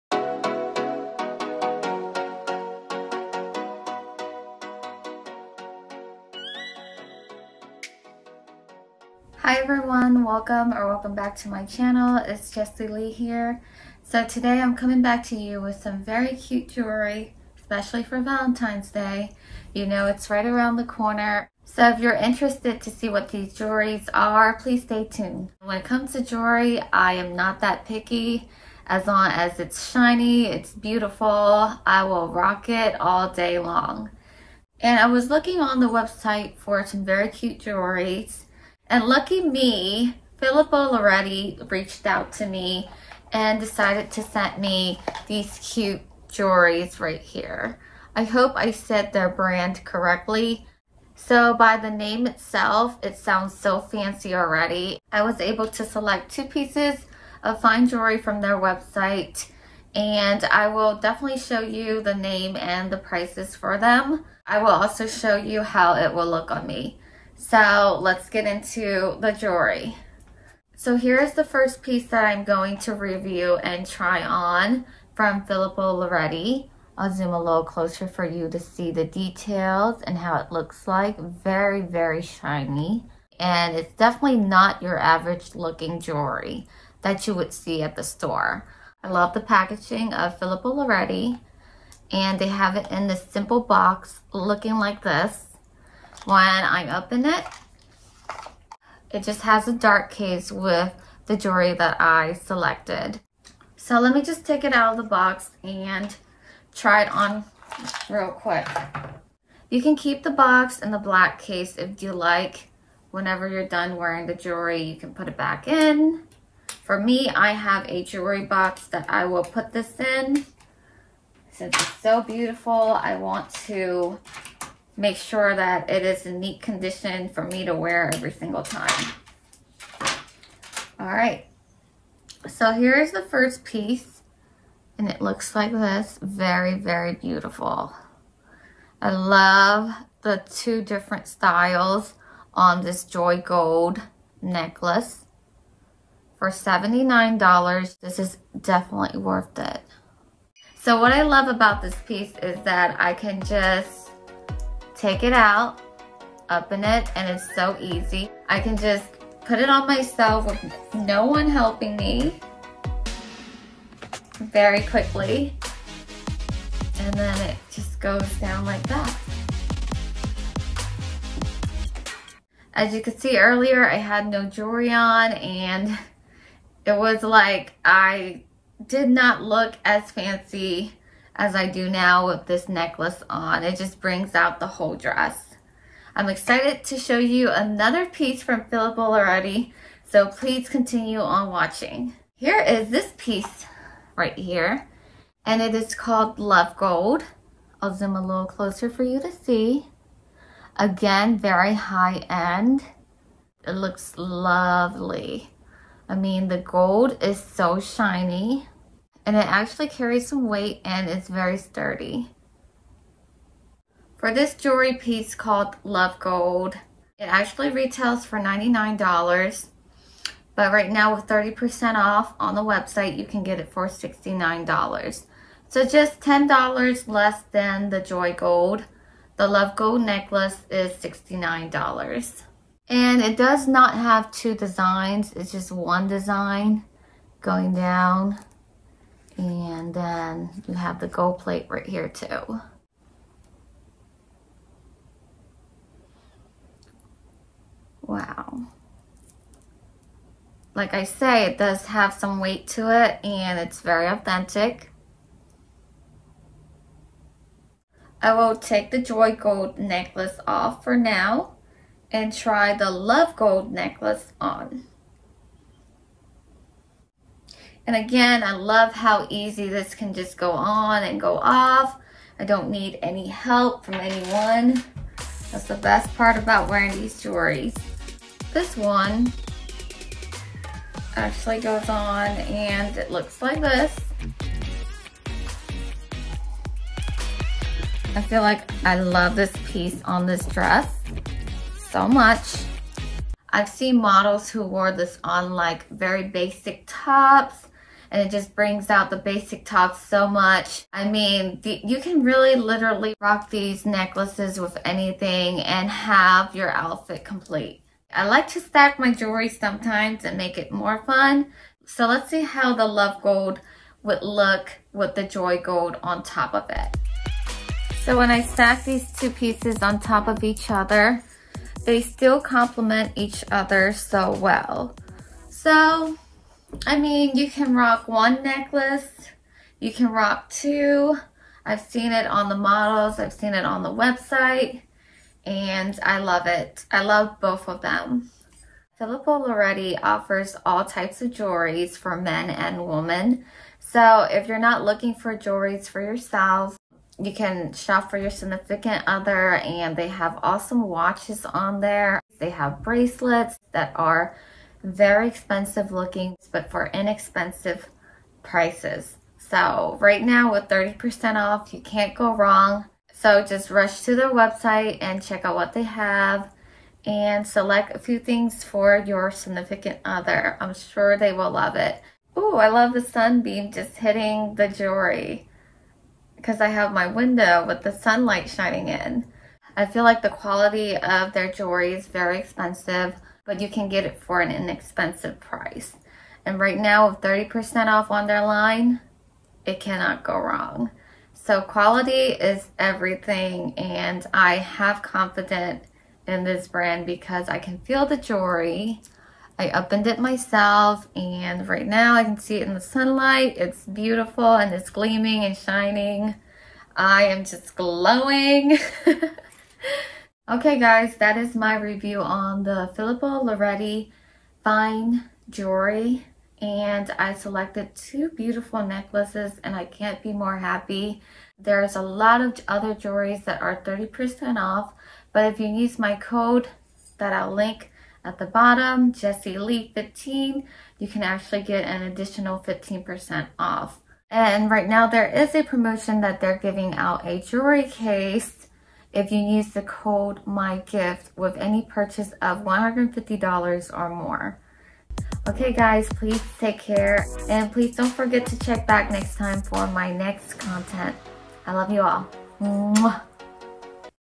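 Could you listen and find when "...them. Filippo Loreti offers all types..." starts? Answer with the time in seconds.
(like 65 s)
337 s.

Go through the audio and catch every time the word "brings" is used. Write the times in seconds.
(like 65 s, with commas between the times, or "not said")
184 s, 298 s.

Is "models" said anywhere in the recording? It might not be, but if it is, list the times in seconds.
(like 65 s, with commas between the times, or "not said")
293 s, 332 s.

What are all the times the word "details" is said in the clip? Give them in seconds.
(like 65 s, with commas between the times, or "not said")
79 s.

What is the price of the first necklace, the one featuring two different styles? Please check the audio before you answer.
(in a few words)
$79.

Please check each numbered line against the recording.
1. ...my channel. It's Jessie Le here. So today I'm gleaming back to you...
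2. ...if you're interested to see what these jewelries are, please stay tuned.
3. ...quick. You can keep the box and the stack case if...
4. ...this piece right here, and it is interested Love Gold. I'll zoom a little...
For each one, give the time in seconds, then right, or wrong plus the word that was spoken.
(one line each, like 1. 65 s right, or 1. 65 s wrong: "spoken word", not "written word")
1. 11 s wrong: "coming", not "gleaming"
2. 21 s right
3. 108 s wrong: "black", not "stack"
4. 192 s wrong: "called", not "interested".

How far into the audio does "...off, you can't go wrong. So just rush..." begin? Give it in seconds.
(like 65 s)
361 s.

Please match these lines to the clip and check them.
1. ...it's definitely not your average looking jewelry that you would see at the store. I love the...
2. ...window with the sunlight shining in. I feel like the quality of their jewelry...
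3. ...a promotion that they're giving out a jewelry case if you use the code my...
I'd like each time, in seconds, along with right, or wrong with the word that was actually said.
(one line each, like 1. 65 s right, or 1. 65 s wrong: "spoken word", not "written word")
1. 83 s right
2. 377 s right
3. 435 s right.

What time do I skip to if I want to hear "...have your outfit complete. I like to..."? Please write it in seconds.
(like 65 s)
305 s.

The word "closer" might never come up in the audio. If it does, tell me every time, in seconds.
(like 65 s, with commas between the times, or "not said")
77 s, 198 s.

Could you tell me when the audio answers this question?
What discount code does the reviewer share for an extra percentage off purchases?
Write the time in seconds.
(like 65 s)
429 s.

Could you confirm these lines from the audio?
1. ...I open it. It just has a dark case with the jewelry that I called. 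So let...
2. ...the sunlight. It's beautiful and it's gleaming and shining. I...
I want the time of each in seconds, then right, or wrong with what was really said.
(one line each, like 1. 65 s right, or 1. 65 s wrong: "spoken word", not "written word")
1. 96 s wrong: "selected", not "called"
2. 402 s right.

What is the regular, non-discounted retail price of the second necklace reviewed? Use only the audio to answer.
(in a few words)
$99.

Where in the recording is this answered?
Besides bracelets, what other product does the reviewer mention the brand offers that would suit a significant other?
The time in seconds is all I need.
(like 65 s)
350 s.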